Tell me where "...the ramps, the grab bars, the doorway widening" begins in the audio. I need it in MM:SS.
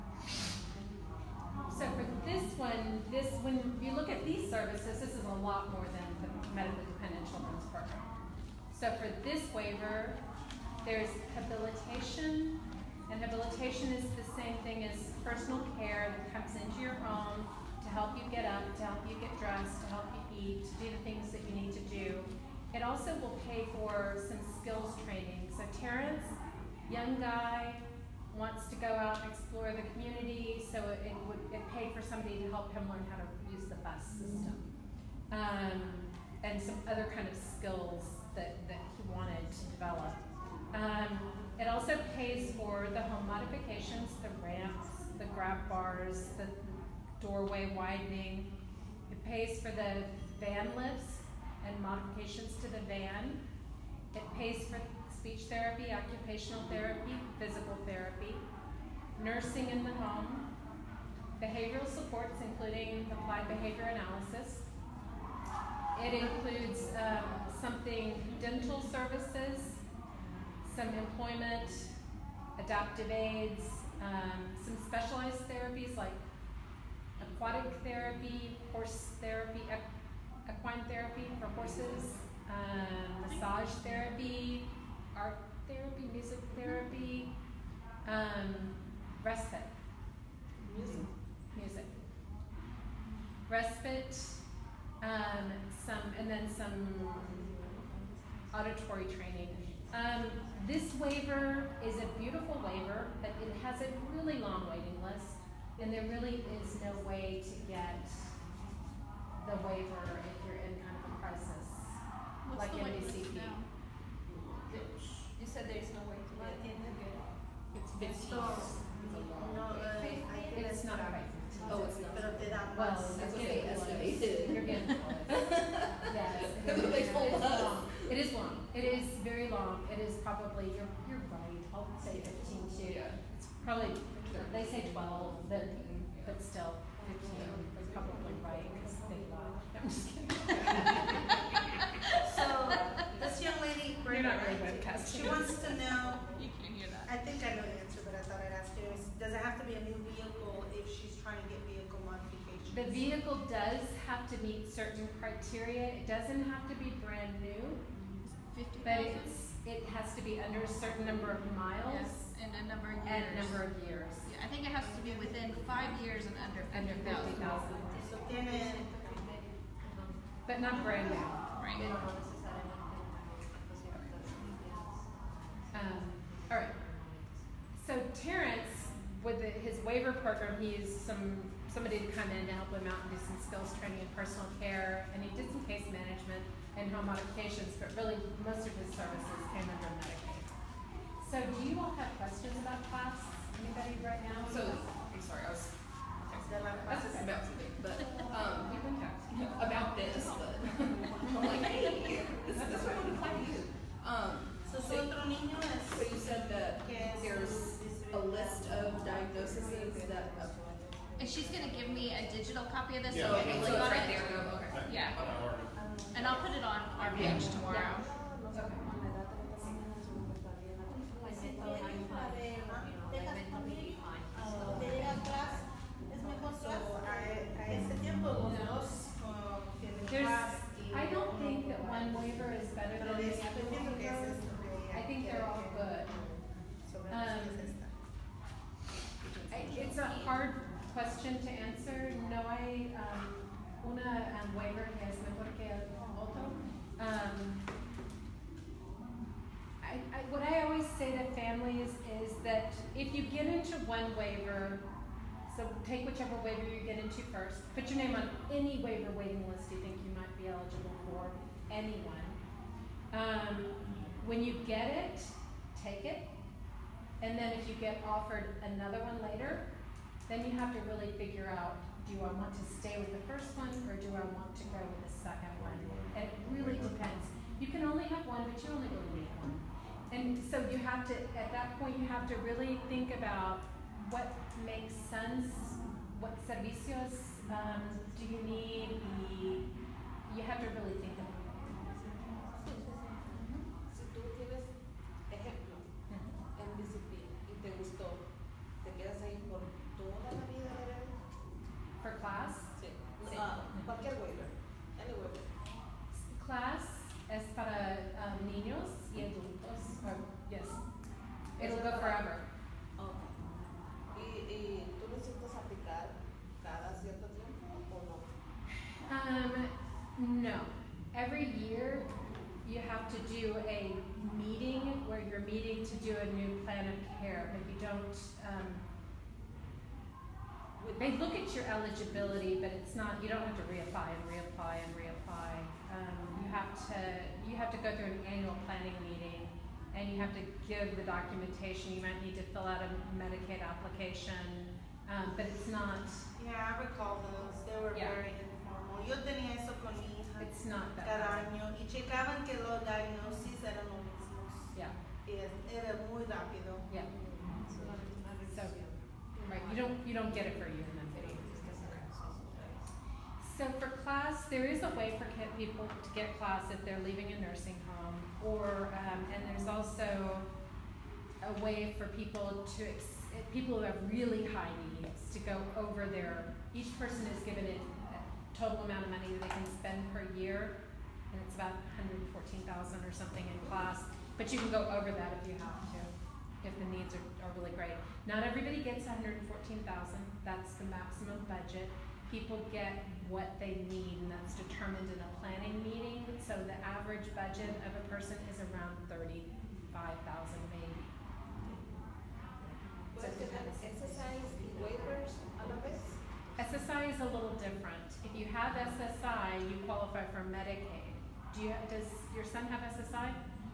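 00:44.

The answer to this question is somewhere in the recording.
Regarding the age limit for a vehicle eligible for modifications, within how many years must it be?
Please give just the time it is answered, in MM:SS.
02:45.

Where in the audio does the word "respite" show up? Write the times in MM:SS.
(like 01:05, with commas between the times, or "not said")
01:29, 01:33.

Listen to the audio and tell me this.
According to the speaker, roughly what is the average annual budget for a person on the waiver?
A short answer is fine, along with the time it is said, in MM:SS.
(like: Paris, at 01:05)
35,000, at 06:39.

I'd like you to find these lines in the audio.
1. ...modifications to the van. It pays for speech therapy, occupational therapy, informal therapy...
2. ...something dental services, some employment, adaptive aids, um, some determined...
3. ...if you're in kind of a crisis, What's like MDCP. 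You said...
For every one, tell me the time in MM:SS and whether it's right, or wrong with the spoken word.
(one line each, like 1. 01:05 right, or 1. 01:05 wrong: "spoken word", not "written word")
1. 00:51 wrong: "physical", not "informal"
2. 01:07 wrong: "specialized", not "determined"
3. 01:50 right.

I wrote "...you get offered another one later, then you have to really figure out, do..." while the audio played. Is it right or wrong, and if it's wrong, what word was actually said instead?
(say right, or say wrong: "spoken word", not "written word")
right.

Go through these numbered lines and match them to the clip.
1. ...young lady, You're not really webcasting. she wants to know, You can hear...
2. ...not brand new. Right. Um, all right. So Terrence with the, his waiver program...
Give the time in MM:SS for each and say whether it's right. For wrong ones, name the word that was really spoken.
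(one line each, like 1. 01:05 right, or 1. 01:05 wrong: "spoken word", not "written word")
1. 02:23 right
2. 02:50 right.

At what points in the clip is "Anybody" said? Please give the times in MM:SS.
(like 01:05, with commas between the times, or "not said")
03:13.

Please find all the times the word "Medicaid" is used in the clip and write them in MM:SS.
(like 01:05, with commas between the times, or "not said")
03:10, 05:43, 06:50.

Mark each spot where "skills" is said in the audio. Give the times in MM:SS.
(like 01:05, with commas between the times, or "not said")
00:37, 03:03.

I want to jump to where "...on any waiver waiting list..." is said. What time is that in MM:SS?
04:18.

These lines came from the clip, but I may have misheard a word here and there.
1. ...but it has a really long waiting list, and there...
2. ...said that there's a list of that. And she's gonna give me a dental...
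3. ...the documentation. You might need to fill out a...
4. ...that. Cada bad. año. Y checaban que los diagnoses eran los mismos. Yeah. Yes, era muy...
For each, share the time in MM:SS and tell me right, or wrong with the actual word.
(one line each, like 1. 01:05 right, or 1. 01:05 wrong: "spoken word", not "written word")
1. 01:43 right
2. 03:26 wrong: "digital", not "dental"
3. 05:40 right
4. 05:50 right.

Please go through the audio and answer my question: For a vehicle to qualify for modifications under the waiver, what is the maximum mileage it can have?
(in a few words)
50,000.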